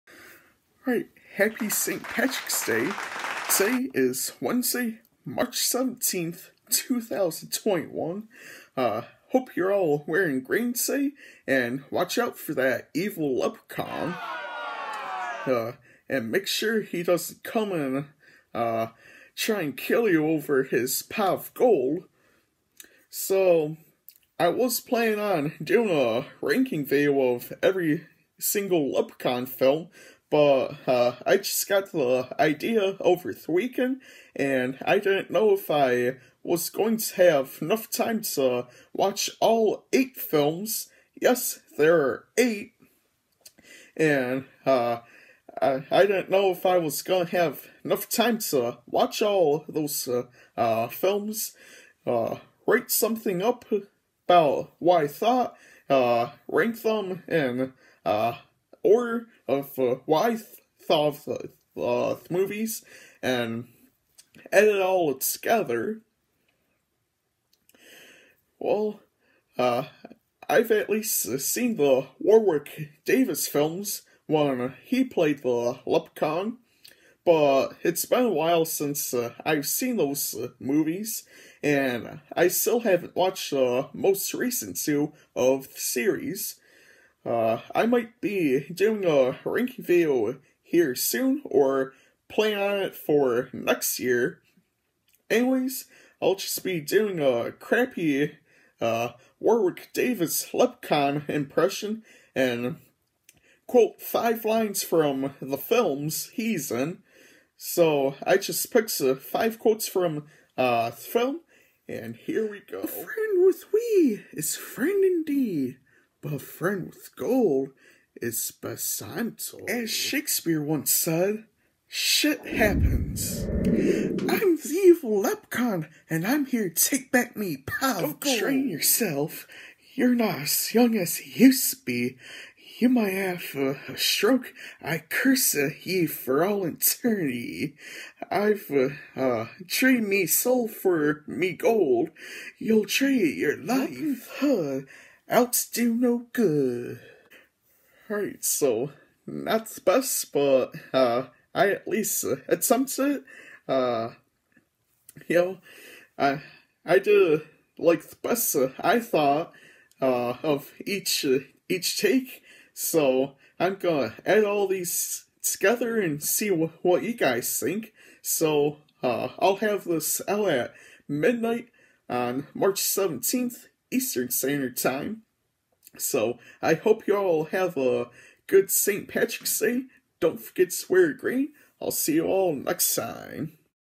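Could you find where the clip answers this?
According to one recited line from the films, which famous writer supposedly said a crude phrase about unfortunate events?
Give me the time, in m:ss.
1:59.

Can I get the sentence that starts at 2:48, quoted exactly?
So uh, I'll have this out at midnight on March 17th Eastern Standard Time.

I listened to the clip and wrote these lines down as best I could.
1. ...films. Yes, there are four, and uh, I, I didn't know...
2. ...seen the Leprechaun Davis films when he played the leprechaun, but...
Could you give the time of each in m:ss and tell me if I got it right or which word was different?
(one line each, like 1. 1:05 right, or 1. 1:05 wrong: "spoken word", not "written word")
1. 0:40 wrong: "eight", not "four"
2. 1:11 wrong: "Warwick", not "Leprechaun".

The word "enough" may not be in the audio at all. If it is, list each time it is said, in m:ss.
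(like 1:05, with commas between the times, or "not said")
0:37, 0:47.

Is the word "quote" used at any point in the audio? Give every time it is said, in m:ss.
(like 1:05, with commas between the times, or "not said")
1:43, 1:49.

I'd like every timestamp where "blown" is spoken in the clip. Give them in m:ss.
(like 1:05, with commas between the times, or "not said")
not said.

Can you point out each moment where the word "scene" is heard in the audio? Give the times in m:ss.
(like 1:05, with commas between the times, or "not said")
not said.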